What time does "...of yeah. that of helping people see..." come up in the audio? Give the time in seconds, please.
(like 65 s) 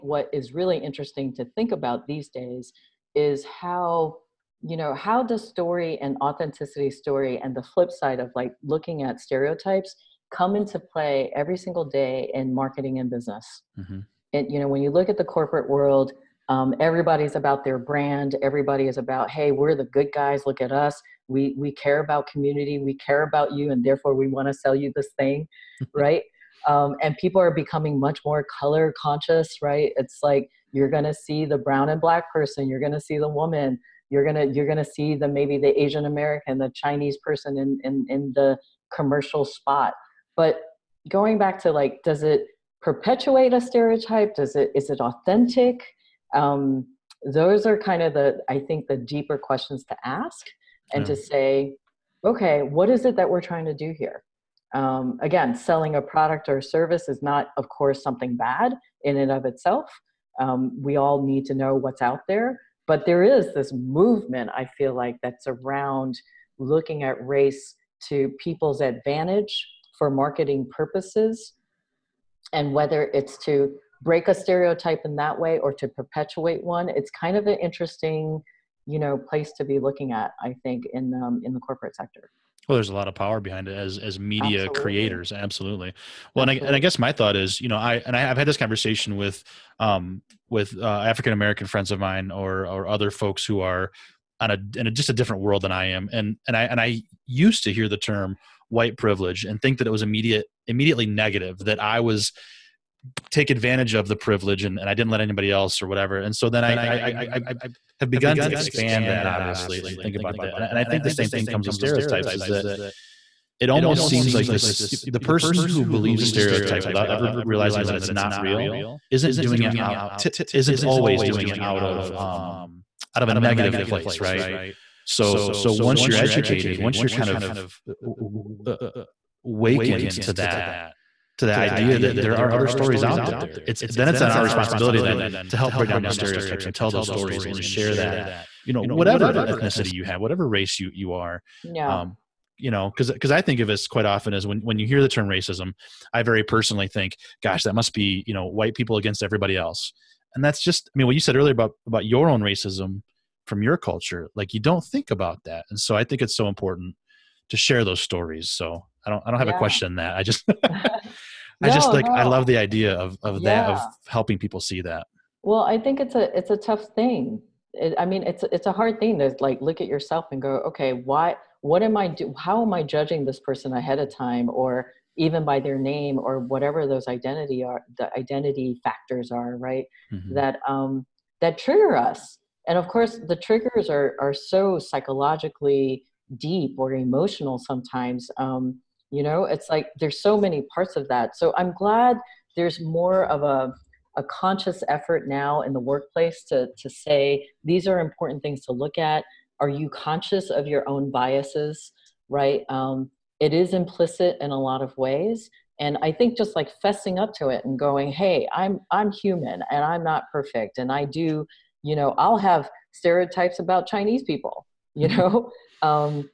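163 s.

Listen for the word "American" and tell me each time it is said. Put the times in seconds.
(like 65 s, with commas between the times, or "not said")
36 s, 91 s.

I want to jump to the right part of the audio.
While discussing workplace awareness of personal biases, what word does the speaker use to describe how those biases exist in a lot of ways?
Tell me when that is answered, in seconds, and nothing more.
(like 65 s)
203 s.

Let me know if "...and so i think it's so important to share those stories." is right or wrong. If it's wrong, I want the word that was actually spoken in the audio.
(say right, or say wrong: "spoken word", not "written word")
right.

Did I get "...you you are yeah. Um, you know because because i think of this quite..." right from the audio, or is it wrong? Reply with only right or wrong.
right.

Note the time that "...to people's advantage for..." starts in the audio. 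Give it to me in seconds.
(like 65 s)
68 s.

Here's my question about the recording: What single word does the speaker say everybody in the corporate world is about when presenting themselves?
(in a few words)
brand.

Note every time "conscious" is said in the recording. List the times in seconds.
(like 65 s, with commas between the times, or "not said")
28 s, 194 s, 199 s.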